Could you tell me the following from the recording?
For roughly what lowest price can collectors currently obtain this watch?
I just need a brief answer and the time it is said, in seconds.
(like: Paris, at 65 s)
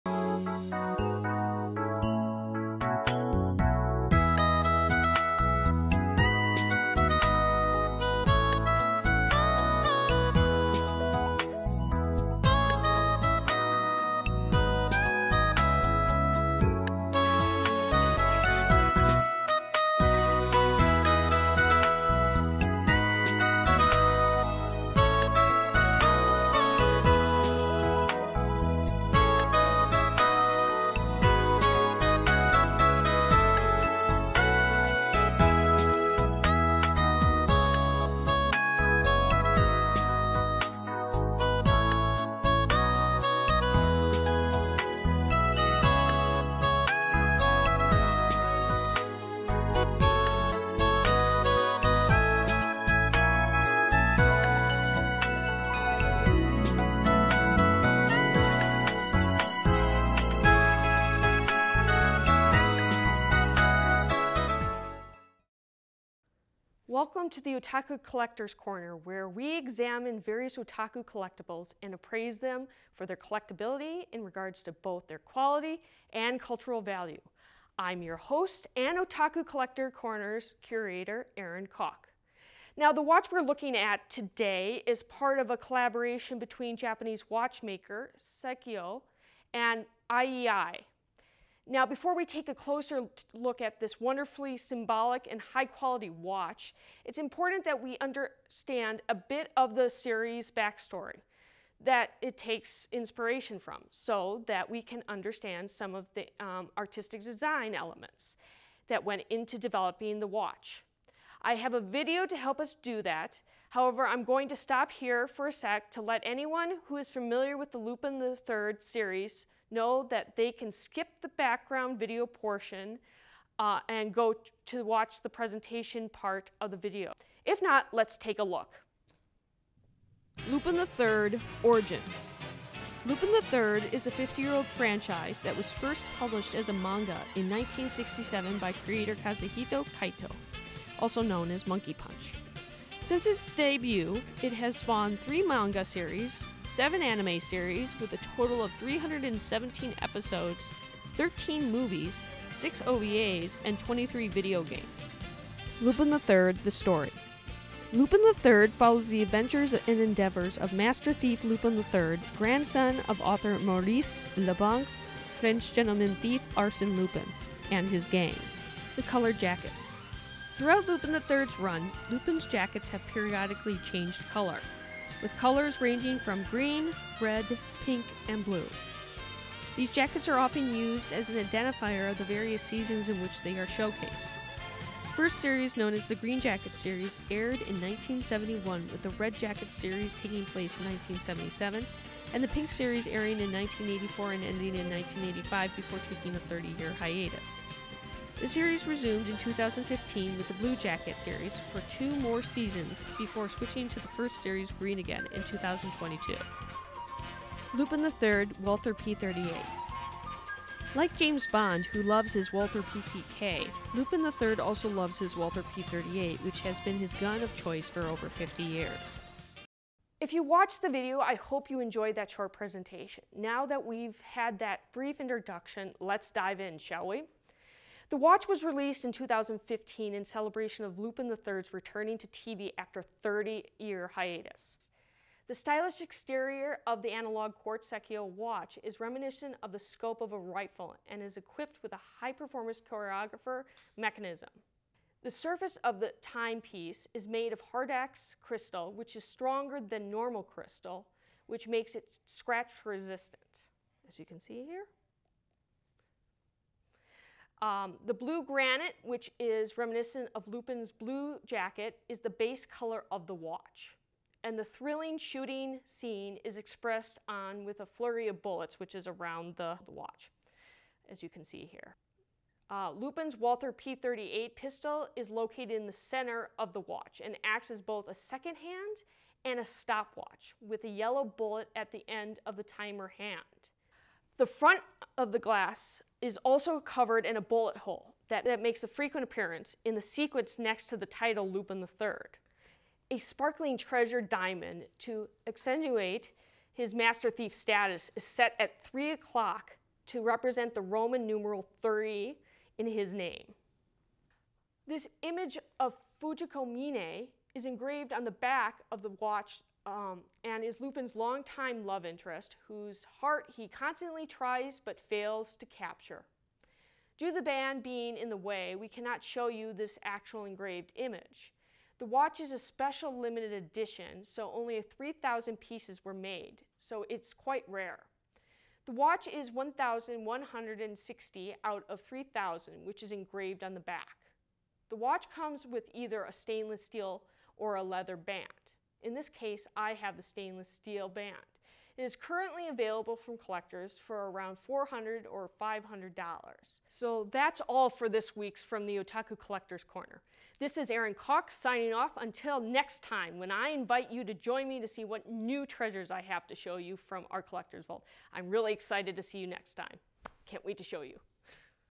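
$400, at 344 s.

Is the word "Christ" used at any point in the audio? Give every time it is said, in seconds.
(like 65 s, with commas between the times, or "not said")
not said.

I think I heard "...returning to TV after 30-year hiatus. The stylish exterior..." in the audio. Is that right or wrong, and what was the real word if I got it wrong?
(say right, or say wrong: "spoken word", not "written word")
right.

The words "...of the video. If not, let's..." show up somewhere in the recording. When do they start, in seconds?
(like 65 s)
126 s.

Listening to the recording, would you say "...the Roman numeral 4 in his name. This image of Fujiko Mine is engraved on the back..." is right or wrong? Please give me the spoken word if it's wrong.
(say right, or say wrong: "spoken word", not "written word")
wrong: "3", not "4".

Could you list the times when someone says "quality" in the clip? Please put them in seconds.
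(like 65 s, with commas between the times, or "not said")
75 s, 95 s.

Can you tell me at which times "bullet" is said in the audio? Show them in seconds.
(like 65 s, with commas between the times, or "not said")
268 s, 281 s, 287 s.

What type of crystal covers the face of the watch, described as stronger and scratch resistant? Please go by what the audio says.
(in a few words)
Hardlex.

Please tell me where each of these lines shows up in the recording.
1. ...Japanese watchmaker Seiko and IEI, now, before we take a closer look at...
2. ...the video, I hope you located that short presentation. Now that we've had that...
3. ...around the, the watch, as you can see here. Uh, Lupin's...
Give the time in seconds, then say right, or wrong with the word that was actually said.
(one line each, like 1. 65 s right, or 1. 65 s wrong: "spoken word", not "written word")
1. 86 s right
2. 220 s wrong: "enjoyed", not "located"
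3. 269 s right.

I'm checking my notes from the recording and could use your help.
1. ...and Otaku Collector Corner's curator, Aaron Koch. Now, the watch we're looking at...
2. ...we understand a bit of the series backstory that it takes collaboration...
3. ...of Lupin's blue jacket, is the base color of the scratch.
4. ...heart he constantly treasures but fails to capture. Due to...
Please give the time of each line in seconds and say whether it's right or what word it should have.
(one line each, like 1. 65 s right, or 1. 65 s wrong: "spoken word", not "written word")
1. 78 s right
2. 97 s wrong: "inspiration", not "collaboration"
3. 260 s wrong: "watch", not "scratch"
4. 313 s wrong: "tries", not "treasures".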